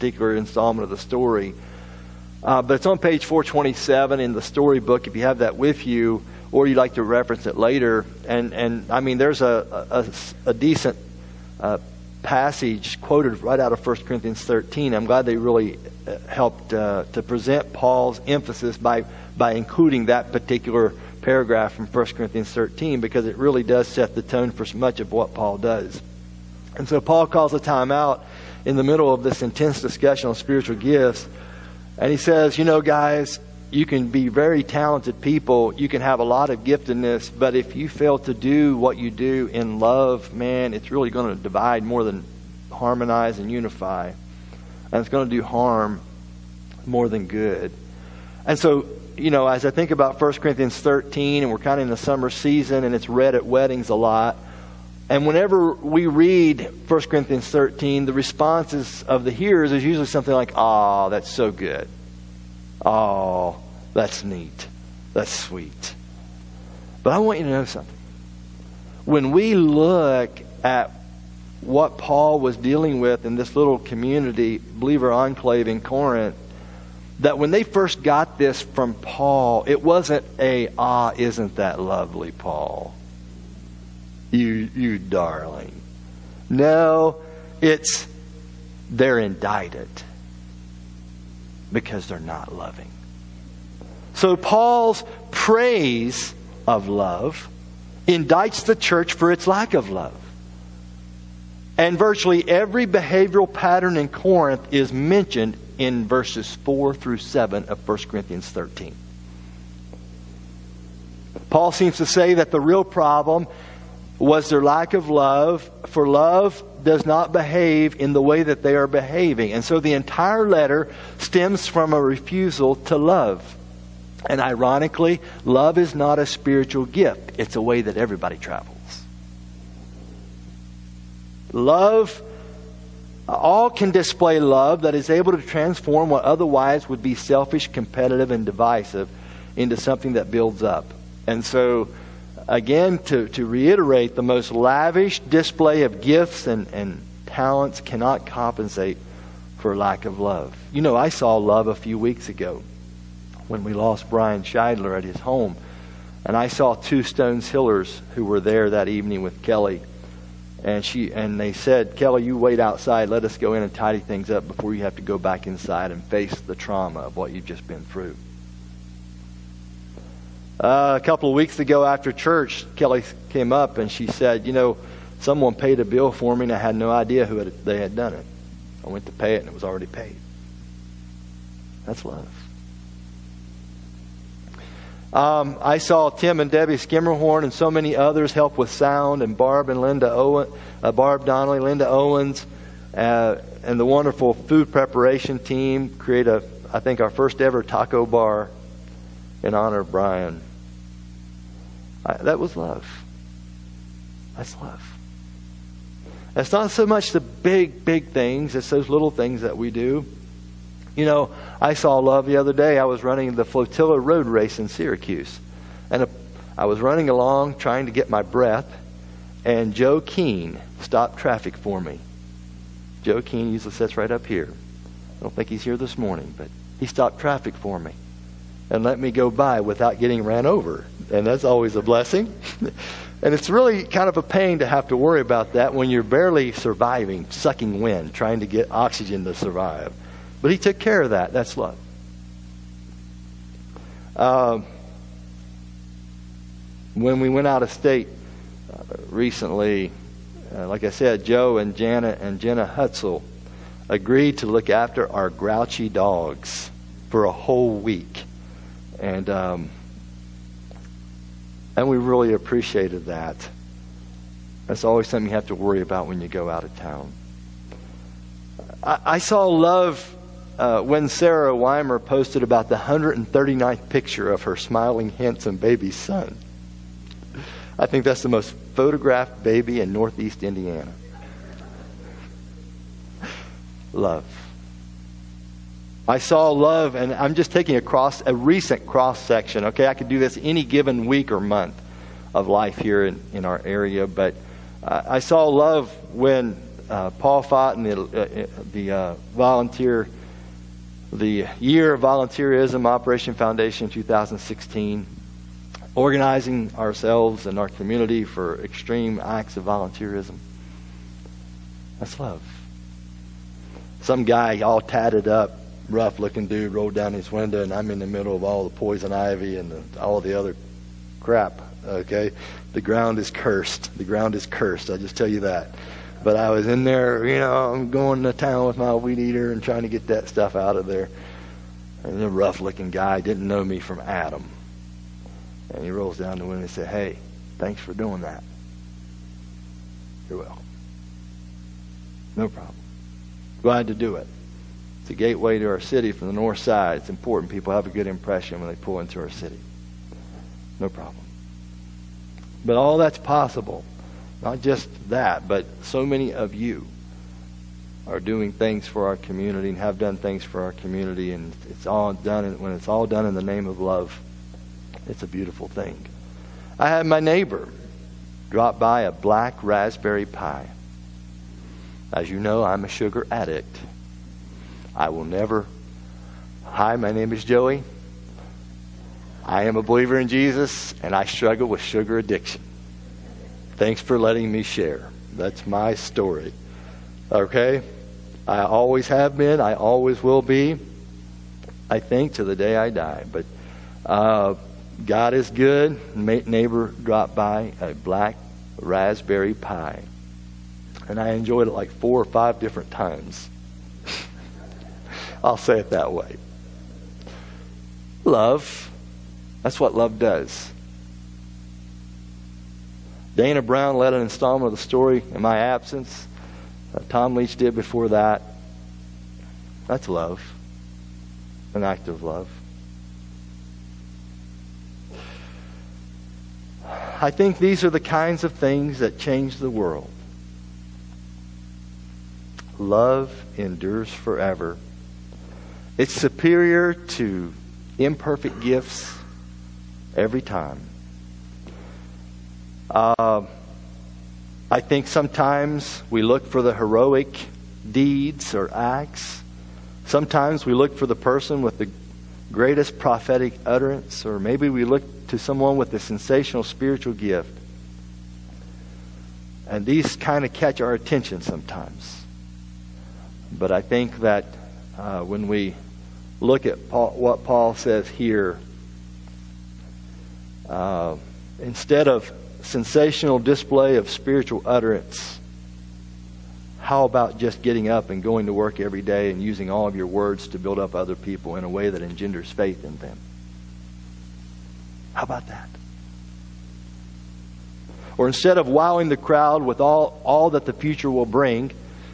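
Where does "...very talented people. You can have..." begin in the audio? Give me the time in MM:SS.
00:34.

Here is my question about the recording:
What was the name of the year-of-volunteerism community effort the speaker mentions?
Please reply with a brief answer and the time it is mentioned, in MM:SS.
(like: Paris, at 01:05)
Operation Foundation 2016, at 05:02.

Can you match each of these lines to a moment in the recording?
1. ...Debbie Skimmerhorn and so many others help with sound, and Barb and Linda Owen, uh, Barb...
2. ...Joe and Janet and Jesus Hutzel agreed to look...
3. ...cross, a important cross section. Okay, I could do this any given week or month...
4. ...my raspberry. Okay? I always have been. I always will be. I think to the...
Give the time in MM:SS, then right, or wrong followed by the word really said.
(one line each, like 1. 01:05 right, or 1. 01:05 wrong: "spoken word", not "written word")
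1. 03:06 right
2. 04:11 wrong: "Jenna", not "Jesus"
3. 04:47 wrong: "recent", not "important"
4. 06:25 wrong: "story", not "raspberry".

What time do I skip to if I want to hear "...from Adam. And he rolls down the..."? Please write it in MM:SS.
05:33.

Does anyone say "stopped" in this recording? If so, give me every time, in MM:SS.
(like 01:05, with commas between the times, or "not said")
03:40, 03:46.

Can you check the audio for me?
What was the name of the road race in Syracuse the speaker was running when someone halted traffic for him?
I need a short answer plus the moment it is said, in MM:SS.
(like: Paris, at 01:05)
Flotilla Road Race, at 03:33.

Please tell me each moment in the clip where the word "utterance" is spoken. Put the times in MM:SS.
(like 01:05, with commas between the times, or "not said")
07:33, 07:54.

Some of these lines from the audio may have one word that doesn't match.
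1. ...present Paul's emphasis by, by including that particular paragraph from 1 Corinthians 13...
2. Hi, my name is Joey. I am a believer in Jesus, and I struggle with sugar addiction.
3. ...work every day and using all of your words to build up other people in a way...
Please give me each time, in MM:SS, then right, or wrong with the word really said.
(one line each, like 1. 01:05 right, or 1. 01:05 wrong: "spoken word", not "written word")
1. 00:17 right
2. 06:16 right
3. 07:58 right.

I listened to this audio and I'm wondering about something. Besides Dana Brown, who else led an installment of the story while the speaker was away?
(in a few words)
Tom Leach.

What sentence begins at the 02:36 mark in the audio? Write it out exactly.
And I saw two Stones Hillers who were there that evening with Kelly and she and they said, Kelly, you wait outside.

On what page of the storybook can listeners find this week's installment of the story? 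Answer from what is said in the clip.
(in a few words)
427.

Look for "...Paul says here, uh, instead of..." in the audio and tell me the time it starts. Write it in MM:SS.
07:47.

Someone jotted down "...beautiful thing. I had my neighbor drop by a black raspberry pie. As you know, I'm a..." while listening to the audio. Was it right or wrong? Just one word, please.
right.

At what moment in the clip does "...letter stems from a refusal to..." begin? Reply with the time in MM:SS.
02:00.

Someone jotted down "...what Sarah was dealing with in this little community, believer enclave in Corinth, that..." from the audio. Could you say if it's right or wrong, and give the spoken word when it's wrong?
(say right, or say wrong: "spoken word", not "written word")
wrong: "Paul", not "Sarah".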